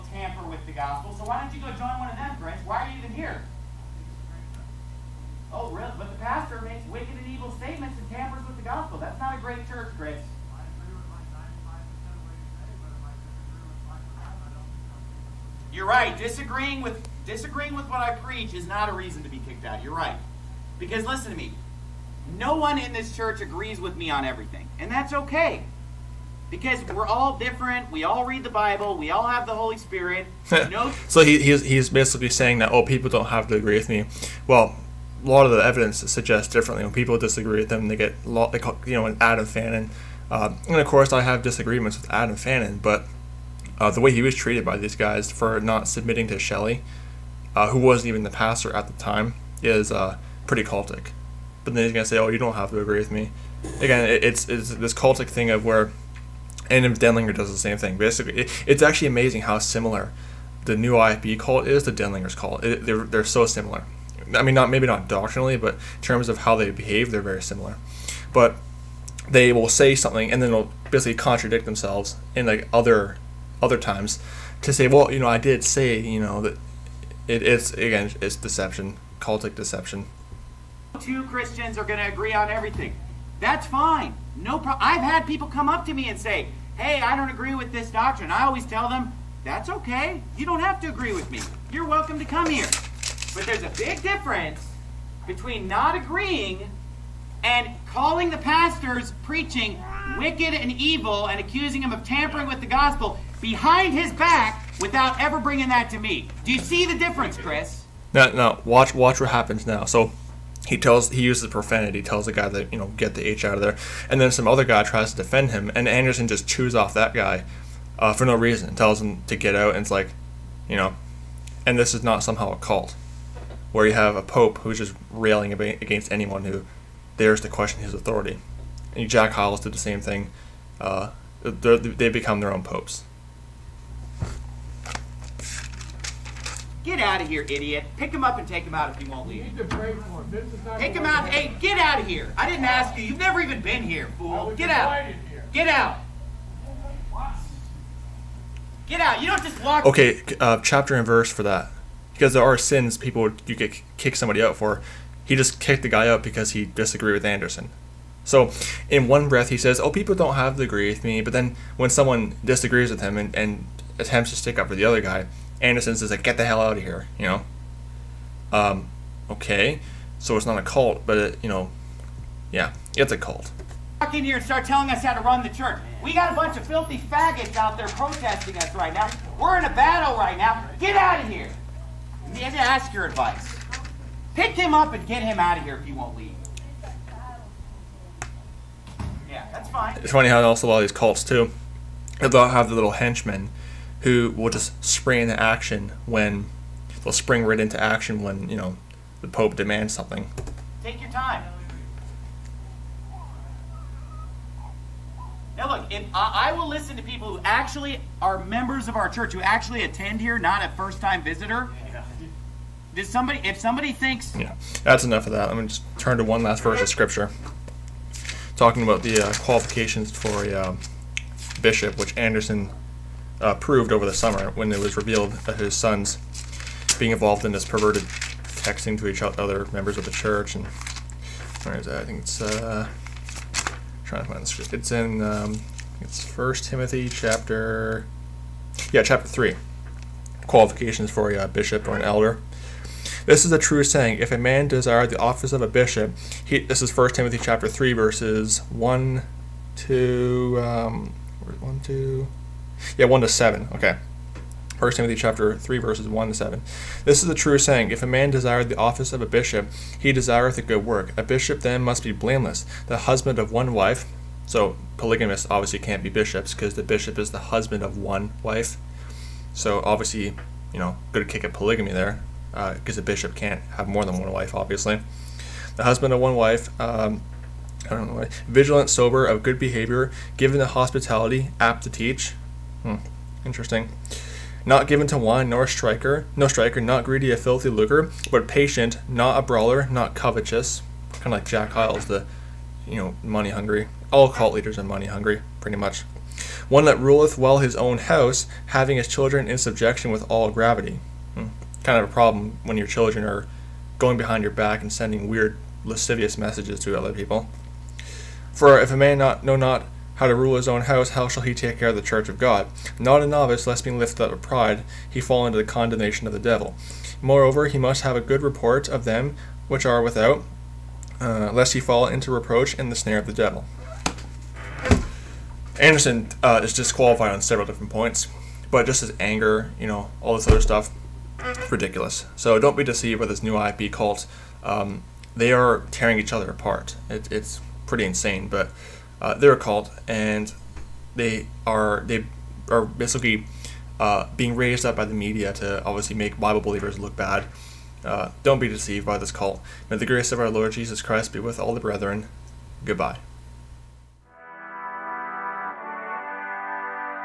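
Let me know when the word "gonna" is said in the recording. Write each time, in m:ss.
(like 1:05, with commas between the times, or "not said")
0:51, 3:35.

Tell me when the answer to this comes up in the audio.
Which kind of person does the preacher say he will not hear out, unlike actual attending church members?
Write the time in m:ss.
3:30.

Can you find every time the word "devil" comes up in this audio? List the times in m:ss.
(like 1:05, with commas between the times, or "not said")
5:16, 5:23.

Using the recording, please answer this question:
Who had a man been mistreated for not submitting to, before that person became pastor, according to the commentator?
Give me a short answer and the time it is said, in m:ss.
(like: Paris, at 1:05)
Shelley, at 0:46.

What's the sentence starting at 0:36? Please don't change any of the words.
When people disagree with them, they get, lot, they call, you know, an Adam Fannin.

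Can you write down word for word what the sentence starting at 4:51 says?
Kind of like Jack Hyles, the, you know, money hungry.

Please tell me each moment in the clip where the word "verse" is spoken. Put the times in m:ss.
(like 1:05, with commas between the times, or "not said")
2:31, 3:36, 4:07, 4:15.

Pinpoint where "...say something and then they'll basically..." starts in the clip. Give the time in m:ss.
1:09.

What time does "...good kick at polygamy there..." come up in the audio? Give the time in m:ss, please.
4:31.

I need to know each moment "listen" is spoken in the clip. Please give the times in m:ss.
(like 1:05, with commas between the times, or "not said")
0:21, 3:26.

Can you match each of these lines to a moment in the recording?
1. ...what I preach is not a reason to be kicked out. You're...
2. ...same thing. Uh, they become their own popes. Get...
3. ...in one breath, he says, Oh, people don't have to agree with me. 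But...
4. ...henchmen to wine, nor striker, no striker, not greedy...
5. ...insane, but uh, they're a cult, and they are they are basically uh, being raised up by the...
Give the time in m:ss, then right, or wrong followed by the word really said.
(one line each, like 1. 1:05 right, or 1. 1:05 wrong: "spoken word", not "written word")
1. 0:17 right
2. 2:09 right
3. 2:38 right
4. 4:44 wrong: "given", not "henchmen"
5. 5:38 right.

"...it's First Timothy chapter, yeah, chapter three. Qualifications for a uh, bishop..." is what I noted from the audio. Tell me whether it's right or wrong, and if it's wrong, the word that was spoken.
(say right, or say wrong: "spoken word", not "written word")
right.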